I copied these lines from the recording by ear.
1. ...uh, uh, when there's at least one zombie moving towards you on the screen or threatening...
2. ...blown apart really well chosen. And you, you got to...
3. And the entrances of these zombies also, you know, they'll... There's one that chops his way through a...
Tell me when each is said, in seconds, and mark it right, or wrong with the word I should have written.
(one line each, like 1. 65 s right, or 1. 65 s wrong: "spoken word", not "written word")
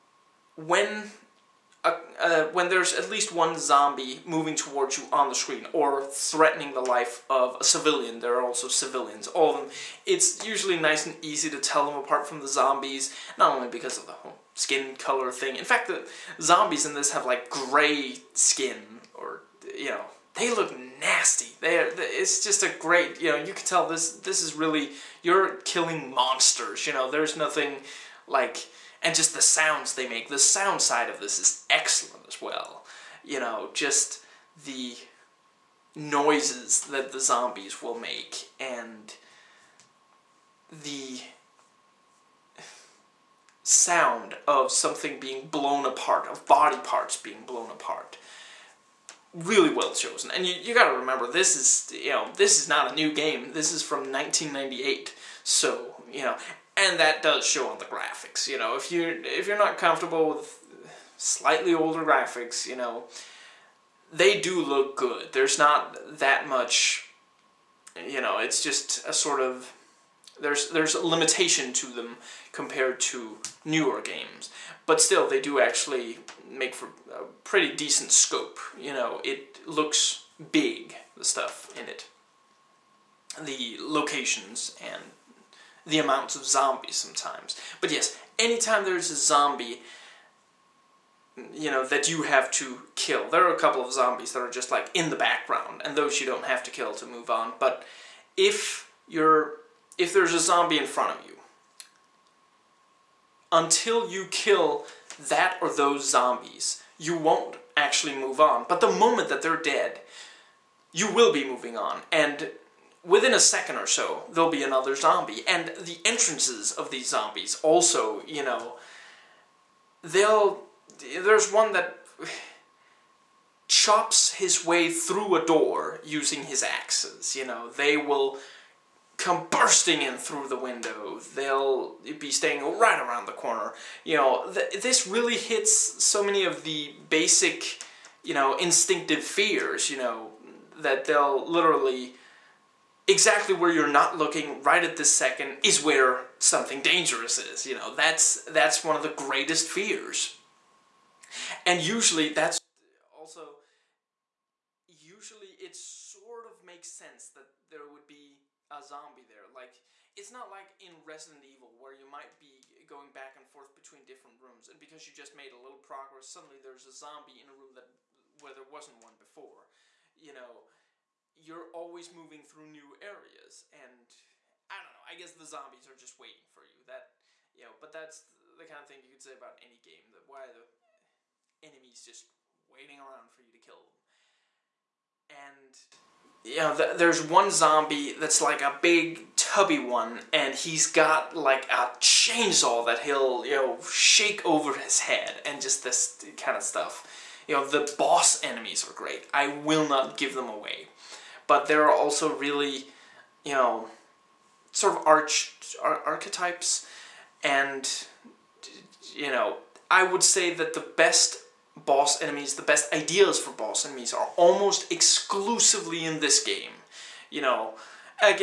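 1. 1 s right
2. 47 s right
3. 115 s right.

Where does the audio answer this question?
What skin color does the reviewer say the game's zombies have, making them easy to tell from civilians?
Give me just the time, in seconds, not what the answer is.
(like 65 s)
17 s.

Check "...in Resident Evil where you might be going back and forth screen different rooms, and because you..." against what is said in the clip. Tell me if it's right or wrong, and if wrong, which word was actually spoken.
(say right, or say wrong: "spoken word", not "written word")
wrong: "between", not "screen".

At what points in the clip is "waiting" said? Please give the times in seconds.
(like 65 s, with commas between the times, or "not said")
176 s, 182 s.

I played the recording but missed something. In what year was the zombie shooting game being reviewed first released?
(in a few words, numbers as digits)
1998.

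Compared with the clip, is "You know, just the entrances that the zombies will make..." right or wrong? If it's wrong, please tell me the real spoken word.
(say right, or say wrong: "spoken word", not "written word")
wrong: "noises", not "entrances".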